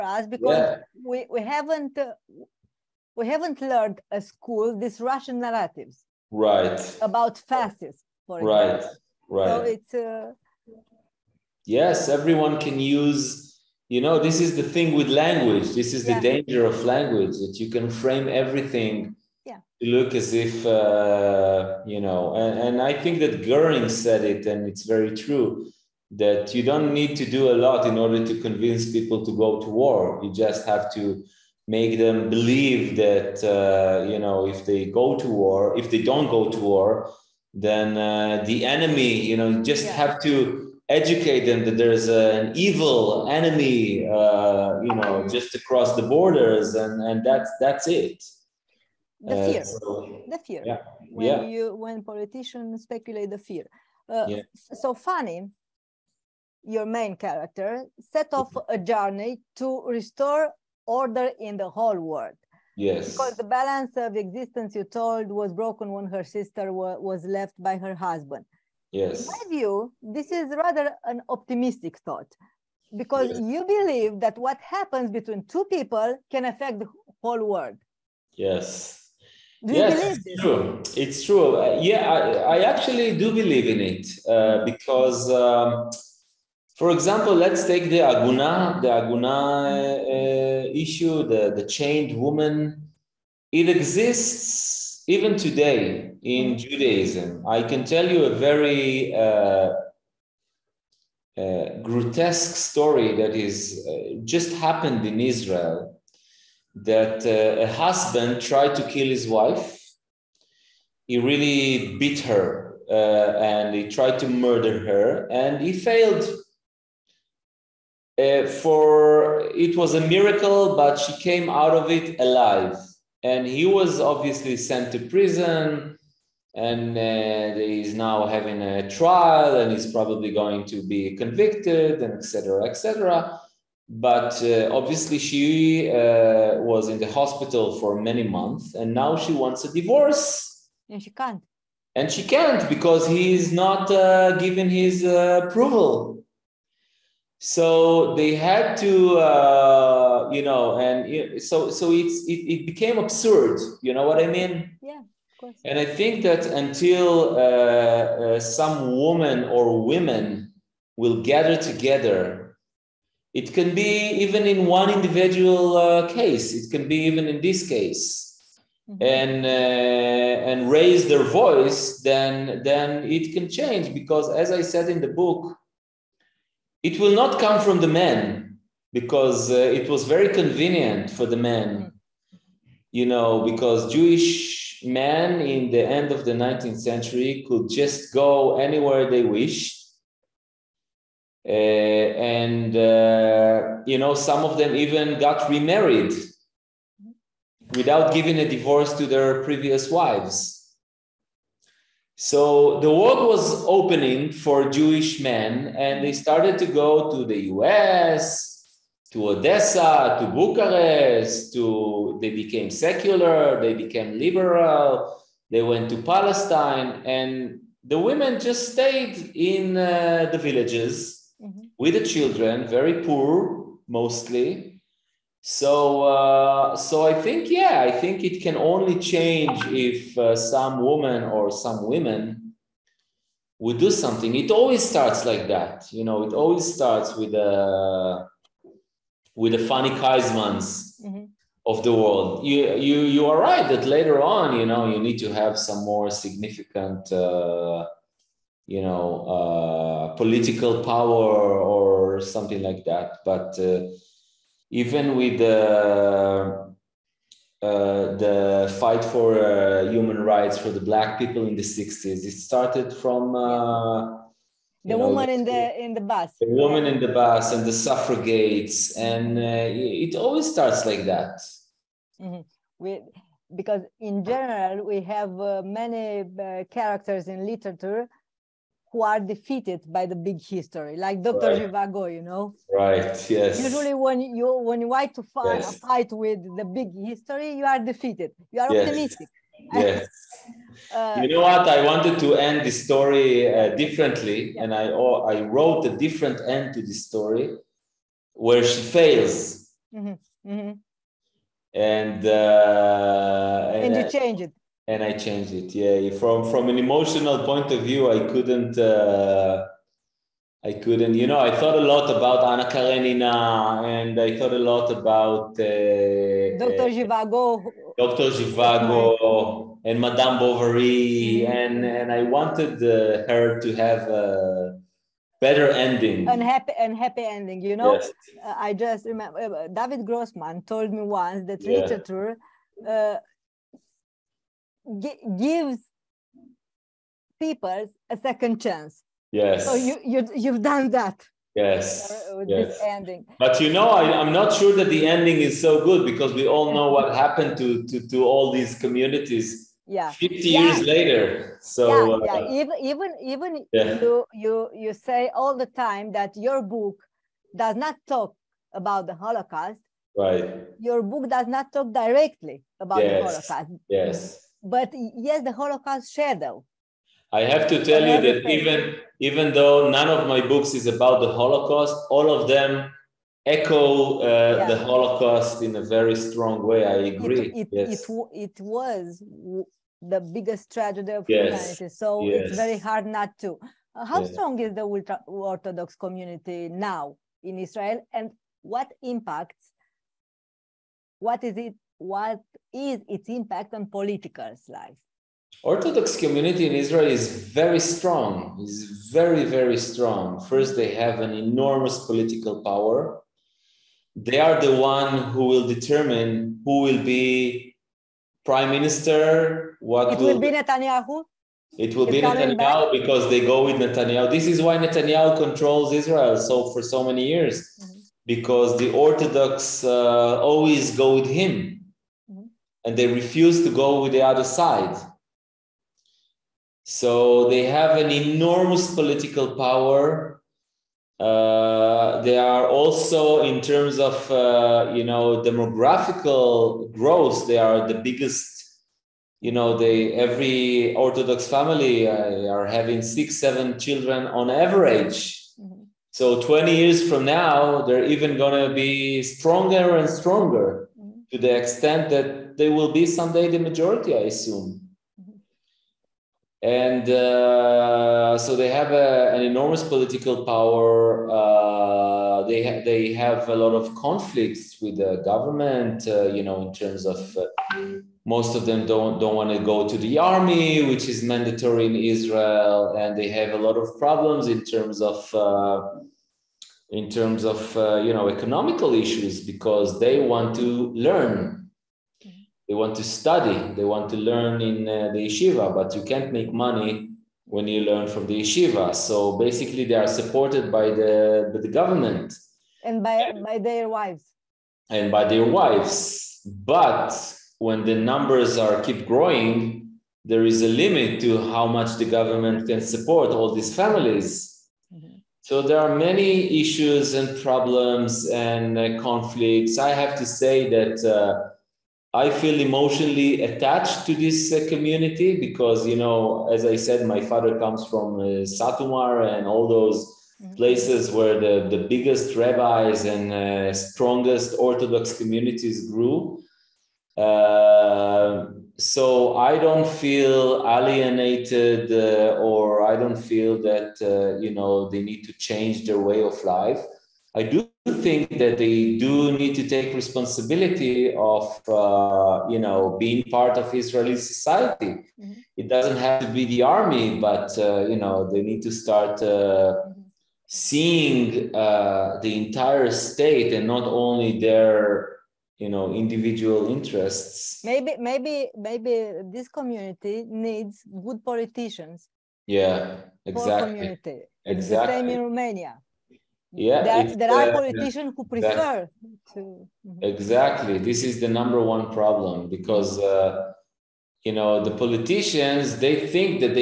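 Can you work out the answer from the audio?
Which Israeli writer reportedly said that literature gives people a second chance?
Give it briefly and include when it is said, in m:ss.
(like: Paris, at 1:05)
David Grossman, at 5:29.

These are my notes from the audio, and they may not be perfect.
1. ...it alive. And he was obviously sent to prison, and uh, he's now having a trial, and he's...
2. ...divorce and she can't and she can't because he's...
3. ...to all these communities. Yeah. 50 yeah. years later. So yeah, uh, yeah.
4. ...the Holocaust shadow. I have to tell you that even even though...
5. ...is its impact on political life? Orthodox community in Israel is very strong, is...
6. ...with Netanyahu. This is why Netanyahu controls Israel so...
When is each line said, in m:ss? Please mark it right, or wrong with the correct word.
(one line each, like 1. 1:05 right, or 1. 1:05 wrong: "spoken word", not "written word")
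1. 2:01 right
2. 2:19 right
3. 5:48 right
4. 6:05 right
5. 6:32 right
6. 6:53 right.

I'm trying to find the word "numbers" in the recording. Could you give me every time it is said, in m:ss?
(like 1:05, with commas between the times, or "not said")
8:17, 9:31.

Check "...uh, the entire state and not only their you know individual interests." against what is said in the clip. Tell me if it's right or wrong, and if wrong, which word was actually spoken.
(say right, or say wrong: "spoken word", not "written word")
right.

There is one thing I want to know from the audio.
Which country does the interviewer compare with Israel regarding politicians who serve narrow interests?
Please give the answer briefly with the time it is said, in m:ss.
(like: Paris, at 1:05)
Romania, at 9:25.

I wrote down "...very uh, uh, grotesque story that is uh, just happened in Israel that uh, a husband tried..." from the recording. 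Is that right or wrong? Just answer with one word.
right.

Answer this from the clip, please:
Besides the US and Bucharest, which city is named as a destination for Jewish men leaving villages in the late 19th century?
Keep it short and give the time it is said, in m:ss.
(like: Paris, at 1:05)
Odessa, at 3:29.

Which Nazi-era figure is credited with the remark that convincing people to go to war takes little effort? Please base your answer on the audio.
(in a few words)
Goering.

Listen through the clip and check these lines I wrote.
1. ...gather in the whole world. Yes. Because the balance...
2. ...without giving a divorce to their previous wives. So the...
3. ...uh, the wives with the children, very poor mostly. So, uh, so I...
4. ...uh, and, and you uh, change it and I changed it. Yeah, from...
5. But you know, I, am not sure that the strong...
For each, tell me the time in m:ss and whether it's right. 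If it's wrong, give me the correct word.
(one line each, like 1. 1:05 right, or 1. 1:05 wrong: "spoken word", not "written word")
1. 1:00 wrong: "order", not "gather"
2. 3:17 right
3. 3:39 wrong: "villages", not "wives"
4. 5:02 right
5. 5:43 wrong: "ending", not "strong".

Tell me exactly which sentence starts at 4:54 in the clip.
and I oh, I wrote a different end to the story, where she fails.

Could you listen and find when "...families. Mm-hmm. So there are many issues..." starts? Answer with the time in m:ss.
8:23.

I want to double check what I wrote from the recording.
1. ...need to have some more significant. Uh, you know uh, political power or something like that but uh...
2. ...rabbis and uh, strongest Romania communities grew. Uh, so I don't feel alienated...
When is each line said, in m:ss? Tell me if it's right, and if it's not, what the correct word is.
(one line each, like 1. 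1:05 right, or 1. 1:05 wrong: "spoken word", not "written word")
1. 4:04 right
2. 8:42 wrong: "Orthodox", not "Romania".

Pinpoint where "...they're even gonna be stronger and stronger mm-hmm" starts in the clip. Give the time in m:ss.
7:27.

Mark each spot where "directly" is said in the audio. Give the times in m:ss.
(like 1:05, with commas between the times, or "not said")
6:01.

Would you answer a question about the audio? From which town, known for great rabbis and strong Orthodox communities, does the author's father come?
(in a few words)
Satu Mare.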